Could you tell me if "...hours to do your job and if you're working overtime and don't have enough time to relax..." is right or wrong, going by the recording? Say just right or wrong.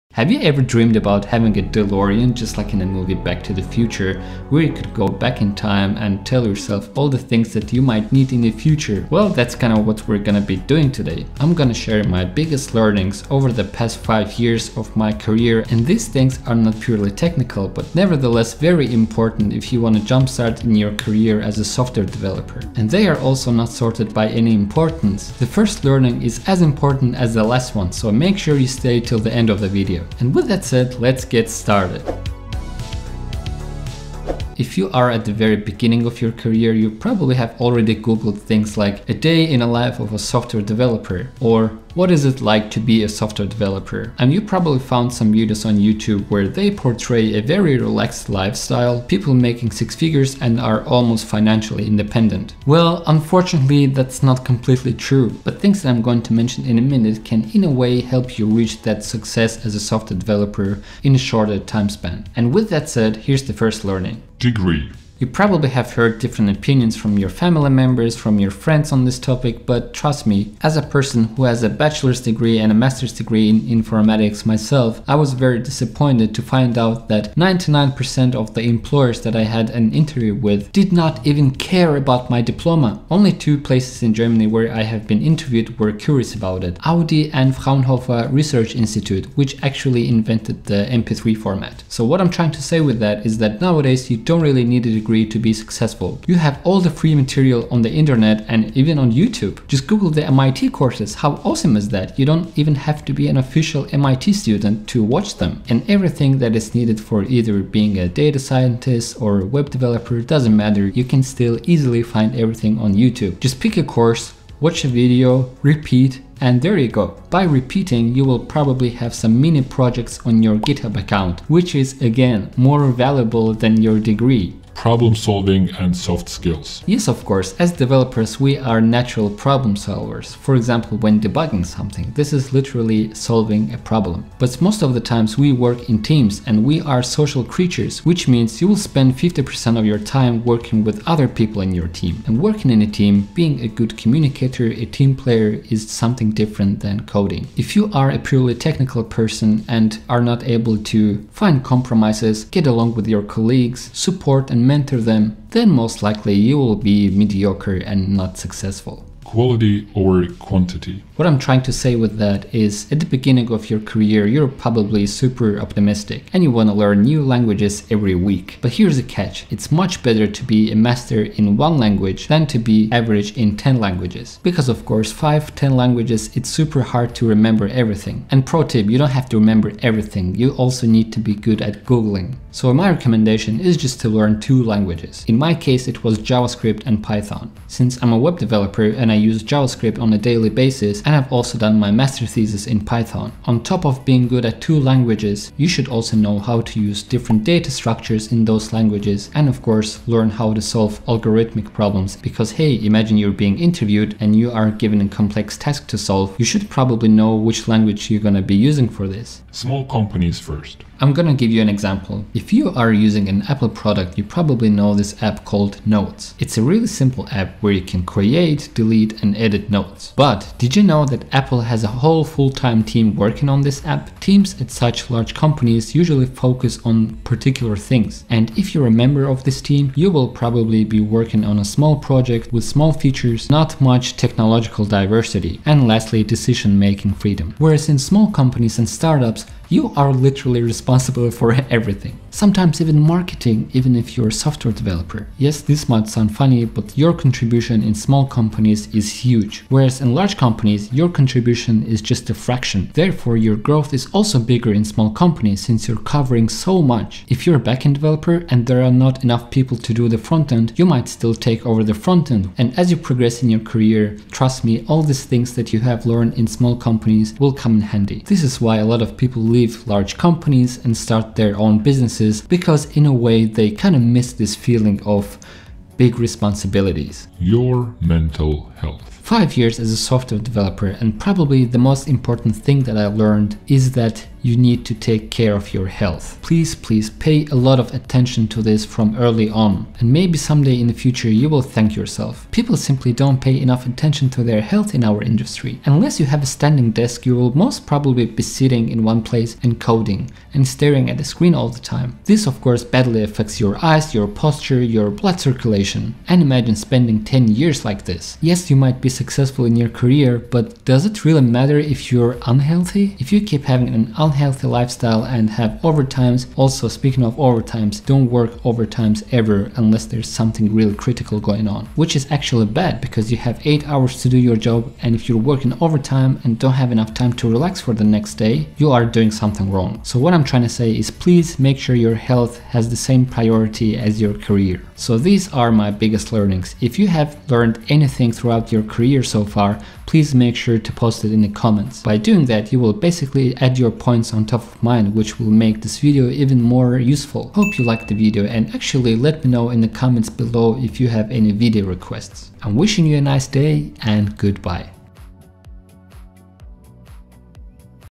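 right.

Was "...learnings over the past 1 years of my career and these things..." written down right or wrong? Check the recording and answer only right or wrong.
wrong.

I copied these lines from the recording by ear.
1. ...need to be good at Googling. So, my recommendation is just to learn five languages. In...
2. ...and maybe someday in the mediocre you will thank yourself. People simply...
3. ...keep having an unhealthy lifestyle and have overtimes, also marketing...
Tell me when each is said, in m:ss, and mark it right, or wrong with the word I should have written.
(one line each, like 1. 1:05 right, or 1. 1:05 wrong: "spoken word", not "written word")
1. 3:00 wrong: "two", not "five"
2. 4:49 wrong: "future", not "mediocre"
3. 5:13 wrong: "speaking", not "marketing".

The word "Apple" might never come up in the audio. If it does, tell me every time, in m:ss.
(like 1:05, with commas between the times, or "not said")
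3:33, 3:41.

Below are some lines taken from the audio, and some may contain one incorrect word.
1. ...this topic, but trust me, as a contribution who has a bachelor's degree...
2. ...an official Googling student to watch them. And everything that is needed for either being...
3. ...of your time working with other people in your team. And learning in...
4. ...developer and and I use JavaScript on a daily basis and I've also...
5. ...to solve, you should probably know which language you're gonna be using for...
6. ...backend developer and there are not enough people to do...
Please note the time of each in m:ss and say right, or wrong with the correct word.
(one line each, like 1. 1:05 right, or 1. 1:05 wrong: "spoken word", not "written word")
1. 1:09 wrong: "person", not "contribution"
2. 1:43 wrong: "MIT", not "Googling"
3. 2:19 wrong: "working", not "learning"
4. 3:08 right
5. 3:25 right
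6. 4:17 right.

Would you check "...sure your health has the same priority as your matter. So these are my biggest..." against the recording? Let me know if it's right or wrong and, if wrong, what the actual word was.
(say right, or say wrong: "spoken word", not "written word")
wrong: "career", not "matter".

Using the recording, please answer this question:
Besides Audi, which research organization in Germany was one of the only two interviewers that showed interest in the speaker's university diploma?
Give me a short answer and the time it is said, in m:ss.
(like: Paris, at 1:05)
Fraunhofer Research Institute, at 1:27.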